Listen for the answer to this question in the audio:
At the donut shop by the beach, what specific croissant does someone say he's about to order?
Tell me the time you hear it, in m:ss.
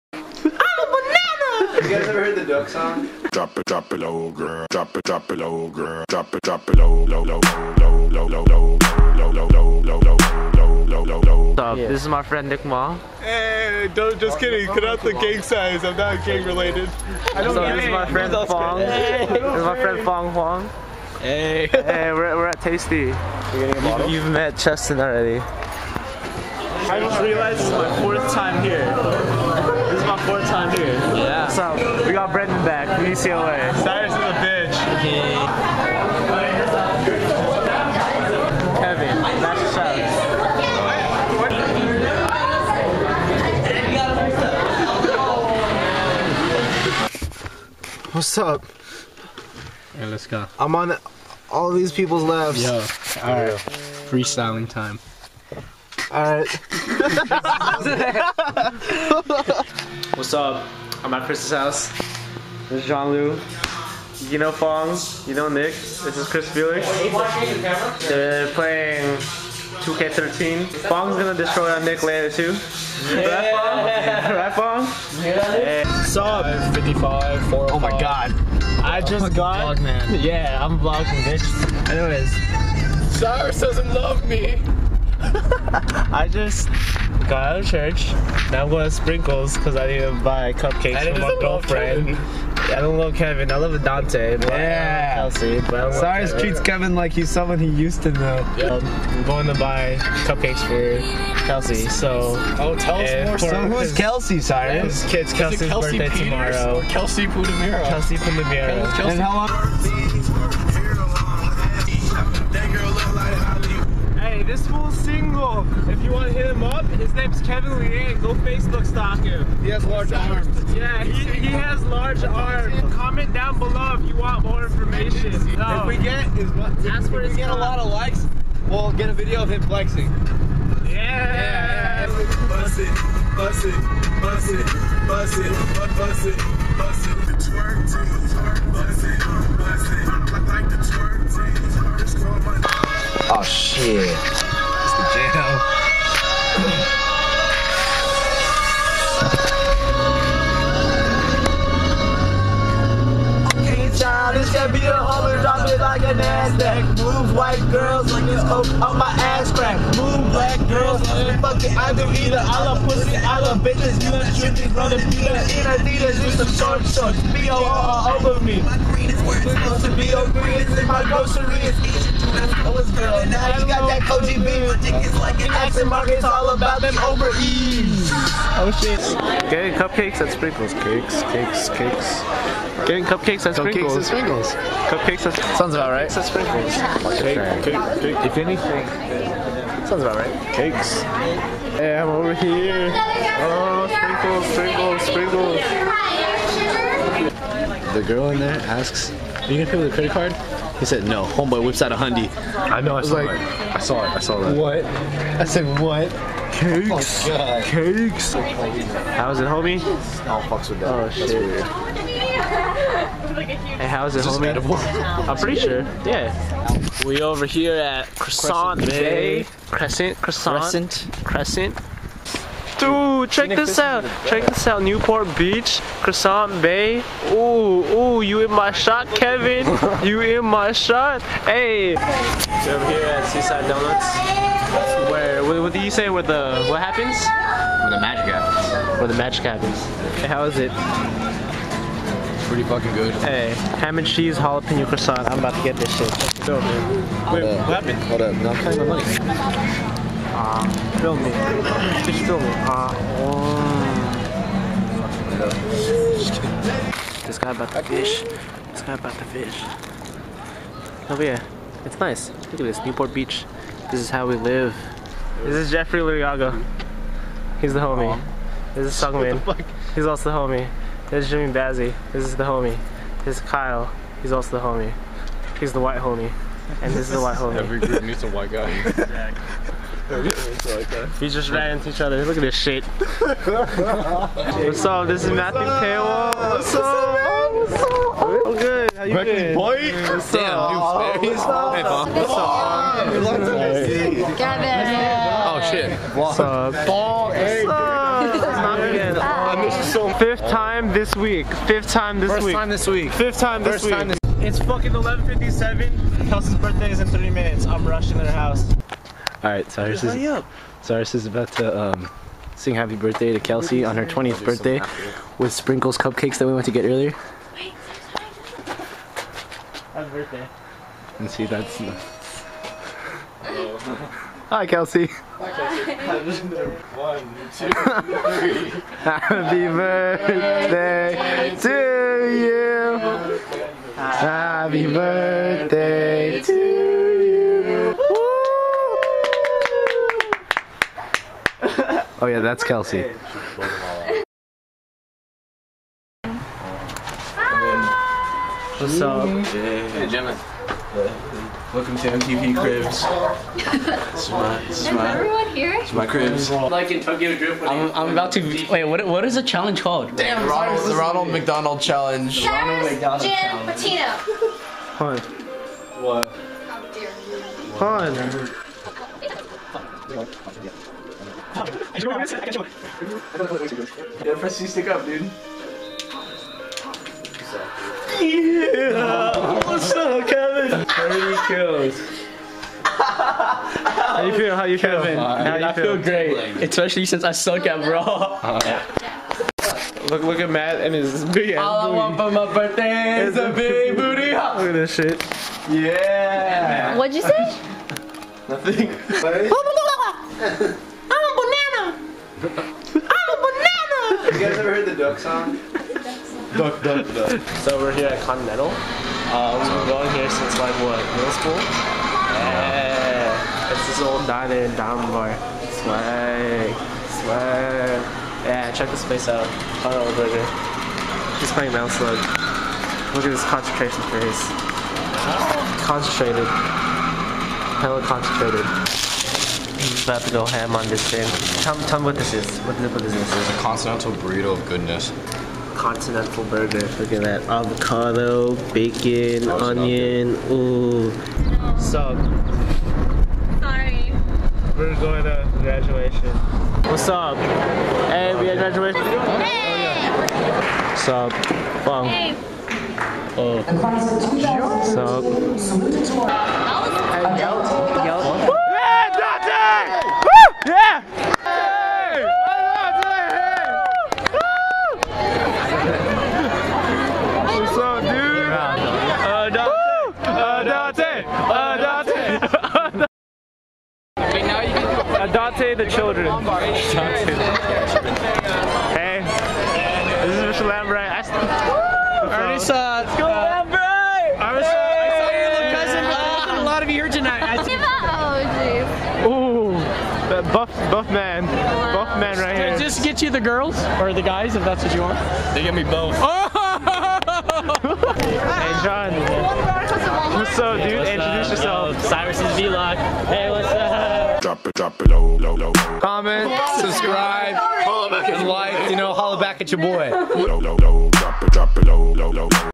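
4:03.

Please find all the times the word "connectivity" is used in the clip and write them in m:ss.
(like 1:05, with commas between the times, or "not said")
not said.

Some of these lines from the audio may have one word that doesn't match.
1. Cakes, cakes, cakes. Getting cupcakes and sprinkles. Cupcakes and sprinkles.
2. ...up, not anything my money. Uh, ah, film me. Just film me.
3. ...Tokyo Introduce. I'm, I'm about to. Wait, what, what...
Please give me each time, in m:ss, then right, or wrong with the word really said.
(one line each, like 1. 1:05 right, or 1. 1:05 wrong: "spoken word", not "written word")
1. 3:00 right
2. 4:08 wrong: "paying", not "anything"
3. 5:56 wrong: "Drift", not "Introduce".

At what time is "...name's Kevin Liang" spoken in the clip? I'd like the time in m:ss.
1:57.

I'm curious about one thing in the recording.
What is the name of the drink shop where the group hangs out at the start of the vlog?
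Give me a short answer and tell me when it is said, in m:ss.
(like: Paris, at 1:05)
Tastea, at 0:22.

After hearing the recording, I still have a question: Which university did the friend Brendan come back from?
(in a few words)
UCLA.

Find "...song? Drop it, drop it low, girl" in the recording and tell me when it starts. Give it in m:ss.
0:02.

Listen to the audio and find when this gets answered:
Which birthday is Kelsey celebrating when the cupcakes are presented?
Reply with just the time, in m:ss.
5:14.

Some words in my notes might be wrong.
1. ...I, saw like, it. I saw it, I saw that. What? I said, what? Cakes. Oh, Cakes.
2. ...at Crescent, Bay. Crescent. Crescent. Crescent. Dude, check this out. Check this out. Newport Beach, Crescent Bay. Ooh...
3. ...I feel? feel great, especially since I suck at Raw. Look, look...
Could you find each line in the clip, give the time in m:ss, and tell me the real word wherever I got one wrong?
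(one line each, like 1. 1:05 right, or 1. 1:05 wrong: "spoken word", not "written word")
1. 3:22 right
2. 3:37 right
3. 6:25 right.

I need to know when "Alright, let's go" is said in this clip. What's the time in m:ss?
0:49.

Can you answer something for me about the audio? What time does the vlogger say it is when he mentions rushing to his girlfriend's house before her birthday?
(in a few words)
11:57.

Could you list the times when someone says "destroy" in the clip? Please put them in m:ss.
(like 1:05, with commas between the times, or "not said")
1:11.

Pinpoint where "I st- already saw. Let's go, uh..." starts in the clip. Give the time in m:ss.
8:01.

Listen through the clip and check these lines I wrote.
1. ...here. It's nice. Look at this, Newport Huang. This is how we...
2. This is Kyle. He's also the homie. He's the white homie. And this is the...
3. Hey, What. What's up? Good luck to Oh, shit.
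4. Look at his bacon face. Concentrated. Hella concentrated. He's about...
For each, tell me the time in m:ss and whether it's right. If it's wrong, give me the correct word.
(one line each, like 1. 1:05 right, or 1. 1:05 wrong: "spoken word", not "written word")
1. 4:21 wrong: "Beach", not "Huang"
2. 4:33 right
3. 4:51 wrong: "Bob", not "What"
4. 7:03 wrong: "concentration", not "bacon".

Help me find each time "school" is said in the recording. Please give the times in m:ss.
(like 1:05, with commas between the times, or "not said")
6:51.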